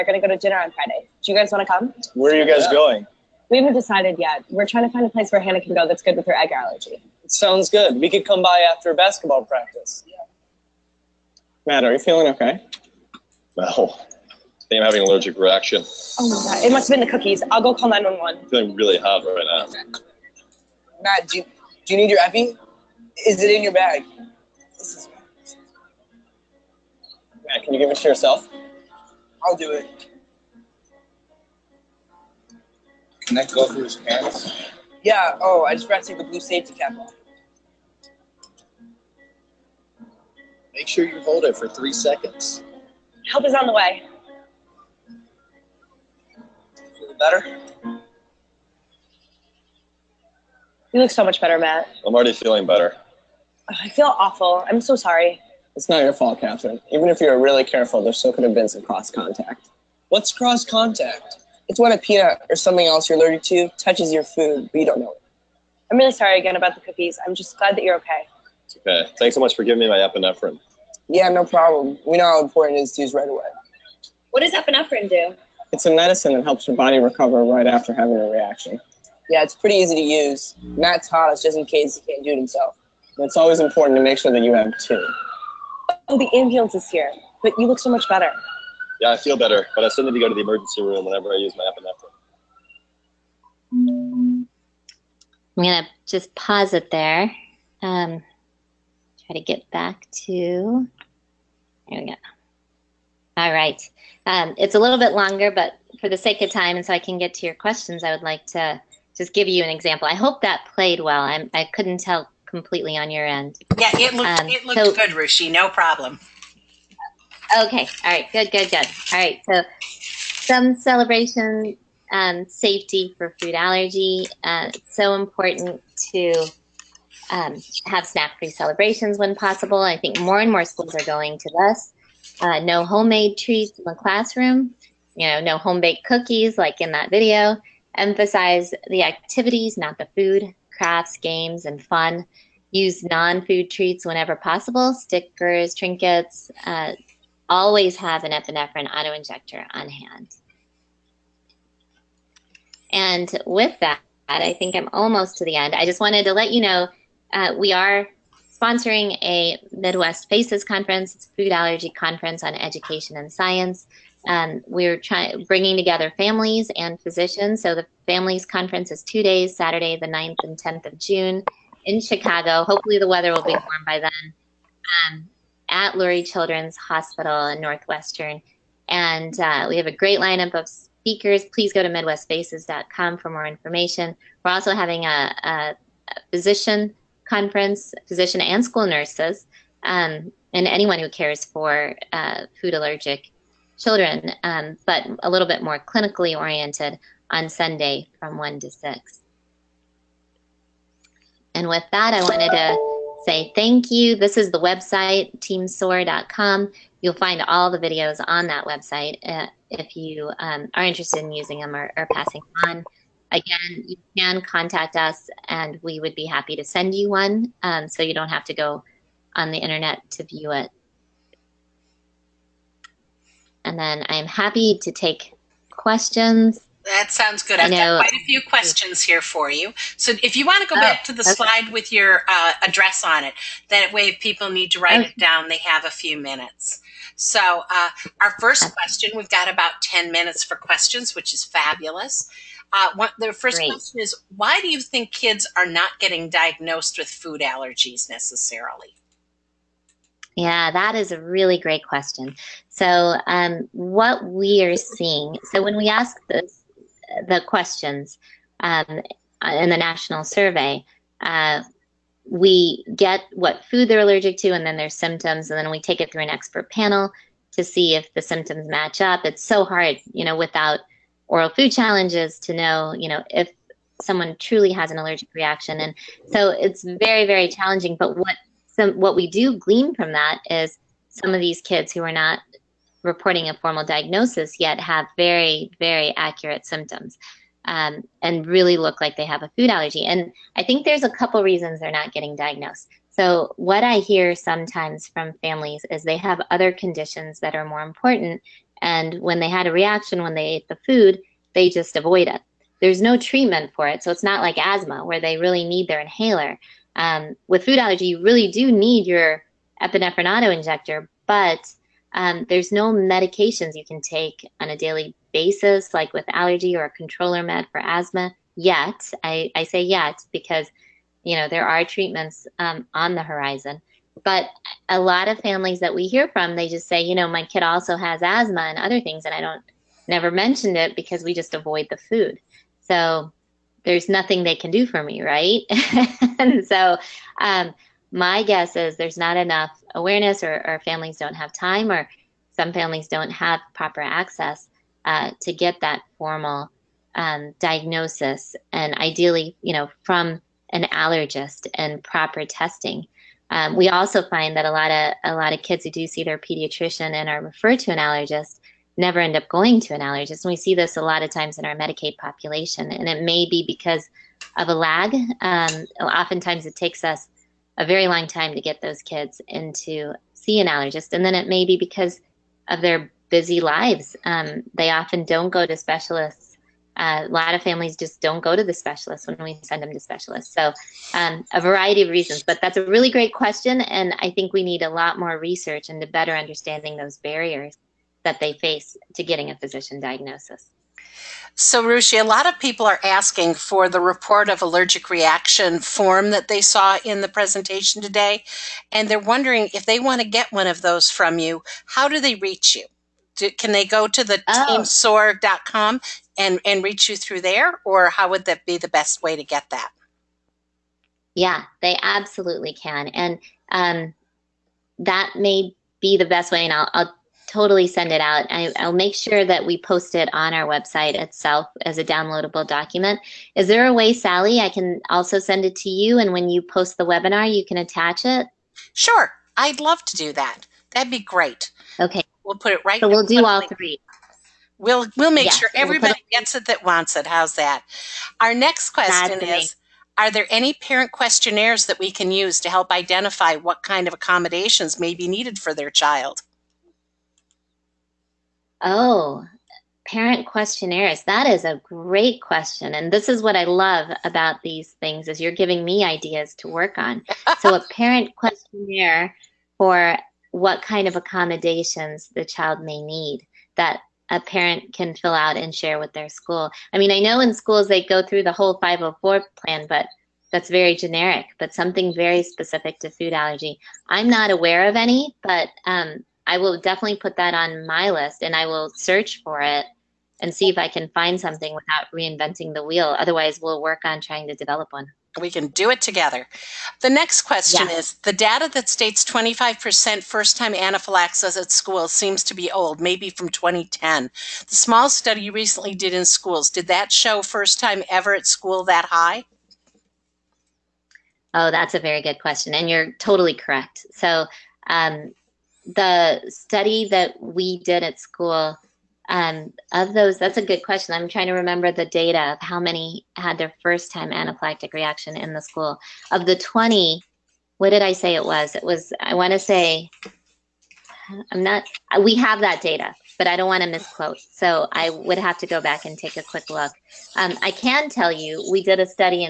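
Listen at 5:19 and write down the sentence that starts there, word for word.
I, I say yet because, you know, there are treatments um, on the horizon.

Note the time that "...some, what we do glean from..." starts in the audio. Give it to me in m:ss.
4:38.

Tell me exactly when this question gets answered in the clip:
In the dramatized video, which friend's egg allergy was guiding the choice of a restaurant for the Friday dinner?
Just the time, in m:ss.
0:05.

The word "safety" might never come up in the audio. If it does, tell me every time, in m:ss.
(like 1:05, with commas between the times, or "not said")
0:36, 2:02.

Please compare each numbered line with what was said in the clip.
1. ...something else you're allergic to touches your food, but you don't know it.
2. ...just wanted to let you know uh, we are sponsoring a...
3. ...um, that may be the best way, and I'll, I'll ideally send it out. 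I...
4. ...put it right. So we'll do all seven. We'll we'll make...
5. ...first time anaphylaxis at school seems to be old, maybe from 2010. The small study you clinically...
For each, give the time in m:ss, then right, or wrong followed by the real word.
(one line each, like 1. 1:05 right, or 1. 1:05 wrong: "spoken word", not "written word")
1. 1:02 right
2. 2:35 right
3. 6:53 wrong: "totally", not "ideally"
4. 7:12 wrong: "three", not "seven"
5. 8:10 wrong: "recently", not "clinically".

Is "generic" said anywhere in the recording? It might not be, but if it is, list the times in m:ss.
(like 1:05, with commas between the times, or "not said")
7:50.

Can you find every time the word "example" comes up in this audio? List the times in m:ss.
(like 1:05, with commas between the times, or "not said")
1:49.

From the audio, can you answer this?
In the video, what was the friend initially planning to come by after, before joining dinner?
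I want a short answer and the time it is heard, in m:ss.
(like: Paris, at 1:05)
basketball practice, at 0:08.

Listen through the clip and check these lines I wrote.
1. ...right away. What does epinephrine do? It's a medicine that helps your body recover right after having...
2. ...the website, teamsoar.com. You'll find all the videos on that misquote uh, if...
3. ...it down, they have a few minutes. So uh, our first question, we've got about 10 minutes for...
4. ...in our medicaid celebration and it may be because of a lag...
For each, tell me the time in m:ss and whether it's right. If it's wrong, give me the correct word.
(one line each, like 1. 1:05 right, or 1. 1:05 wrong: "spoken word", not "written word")
1. 1:13 right
2. 3:24 wrong: "website", not "misquote"
3. 3:55 right
4. 6:01 wrong: "population", not "celebration".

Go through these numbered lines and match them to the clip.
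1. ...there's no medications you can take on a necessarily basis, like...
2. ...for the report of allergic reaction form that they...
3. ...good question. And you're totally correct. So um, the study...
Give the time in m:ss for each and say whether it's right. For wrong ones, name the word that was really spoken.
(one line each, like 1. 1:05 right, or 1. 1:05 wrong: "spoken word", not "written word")
1. 5:12 wrong: "daily", not "necessarily"
2. 6:33 right
3. 8:22 right.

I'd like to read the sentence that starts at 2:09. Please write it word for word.
I think more and more schools are going to this.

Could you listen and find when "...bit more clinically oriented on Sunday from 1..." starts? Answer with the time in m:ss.
3:15.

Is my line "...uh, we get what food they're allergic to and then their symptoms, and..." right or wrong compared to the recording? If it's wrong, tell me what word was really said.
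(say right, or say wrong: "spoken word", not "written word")
right.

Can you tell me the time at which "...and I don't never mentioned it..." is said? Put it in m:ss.
5:29.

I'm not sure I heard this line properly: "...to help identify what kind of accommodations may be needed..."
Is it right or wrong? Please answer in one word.
right.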